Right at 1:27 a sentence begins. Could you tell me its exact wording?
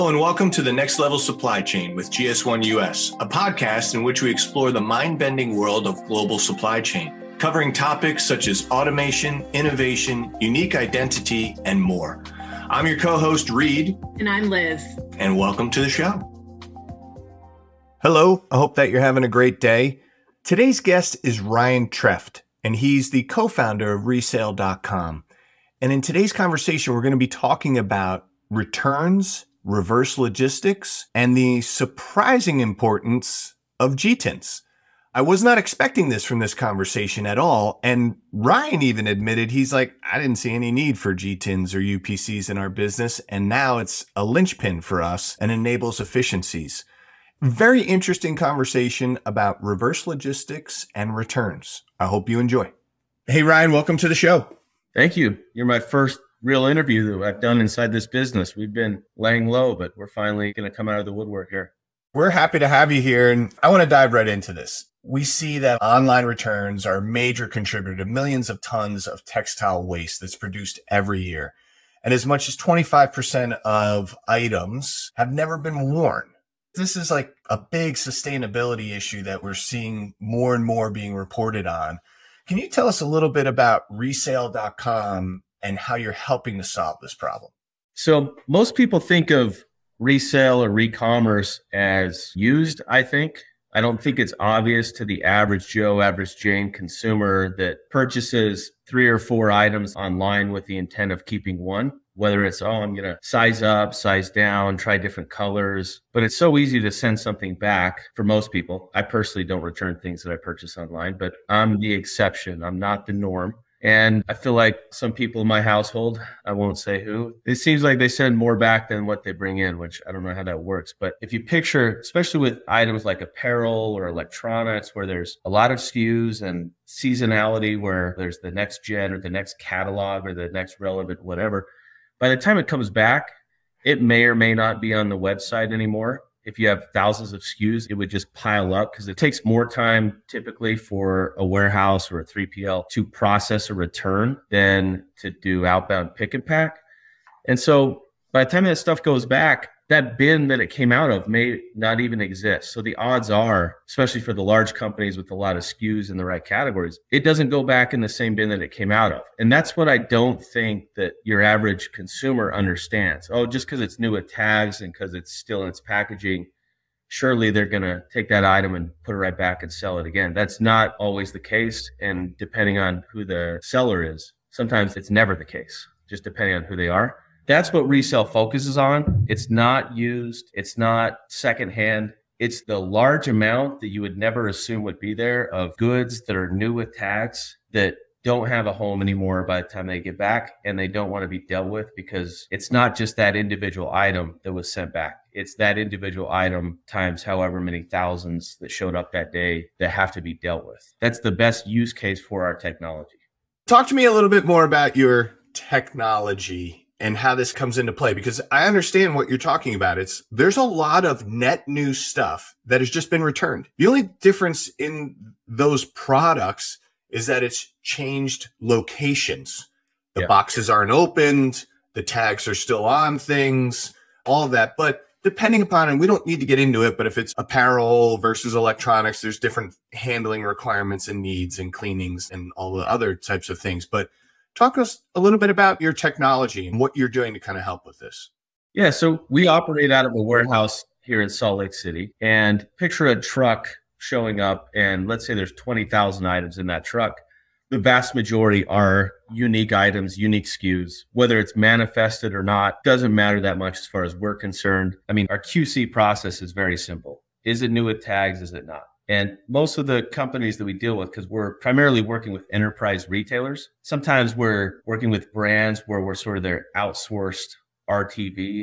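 So most people think of resale or re-commerce as used, I think.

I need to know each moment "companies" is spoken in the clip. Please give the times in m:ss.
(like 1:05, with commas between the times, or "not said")
2:34, 4:20.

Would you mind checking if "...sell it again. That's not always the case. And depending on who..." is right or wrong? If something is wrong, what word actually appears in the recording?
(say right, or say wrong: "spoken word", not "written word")
right.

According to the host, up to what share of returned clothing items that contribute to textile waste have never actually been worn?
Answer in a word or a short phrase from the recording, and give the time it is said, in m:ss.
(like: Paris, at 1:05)
25%, at 1:12.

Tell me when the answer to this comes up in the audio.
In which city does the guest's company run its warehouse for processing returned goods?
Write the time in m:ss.
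4:01.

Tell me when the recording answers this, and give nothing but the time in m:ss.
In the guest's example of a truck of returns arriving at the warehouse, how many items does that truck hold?
4:05.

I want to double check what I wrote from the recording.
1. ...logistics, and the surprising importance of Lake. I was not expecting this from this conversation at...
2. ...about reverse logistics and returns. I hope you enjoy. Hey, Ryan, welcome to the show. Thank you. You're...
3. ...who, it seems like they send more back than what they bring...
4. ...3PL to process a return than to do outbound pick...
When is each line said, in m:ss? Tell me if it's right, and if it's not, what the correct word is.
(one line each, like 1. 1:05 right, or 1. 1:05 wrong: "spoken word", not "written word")
1. 0:30 wrong: "GTINs", not "Lake"
2. 0:49 right
3. 1:57 right
4. 2:22 right.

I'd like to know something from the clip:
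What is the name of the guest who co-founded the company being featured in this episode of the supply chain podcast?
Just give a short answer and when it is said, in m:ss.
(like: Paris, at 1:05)
Ryan Treft, at 0:21.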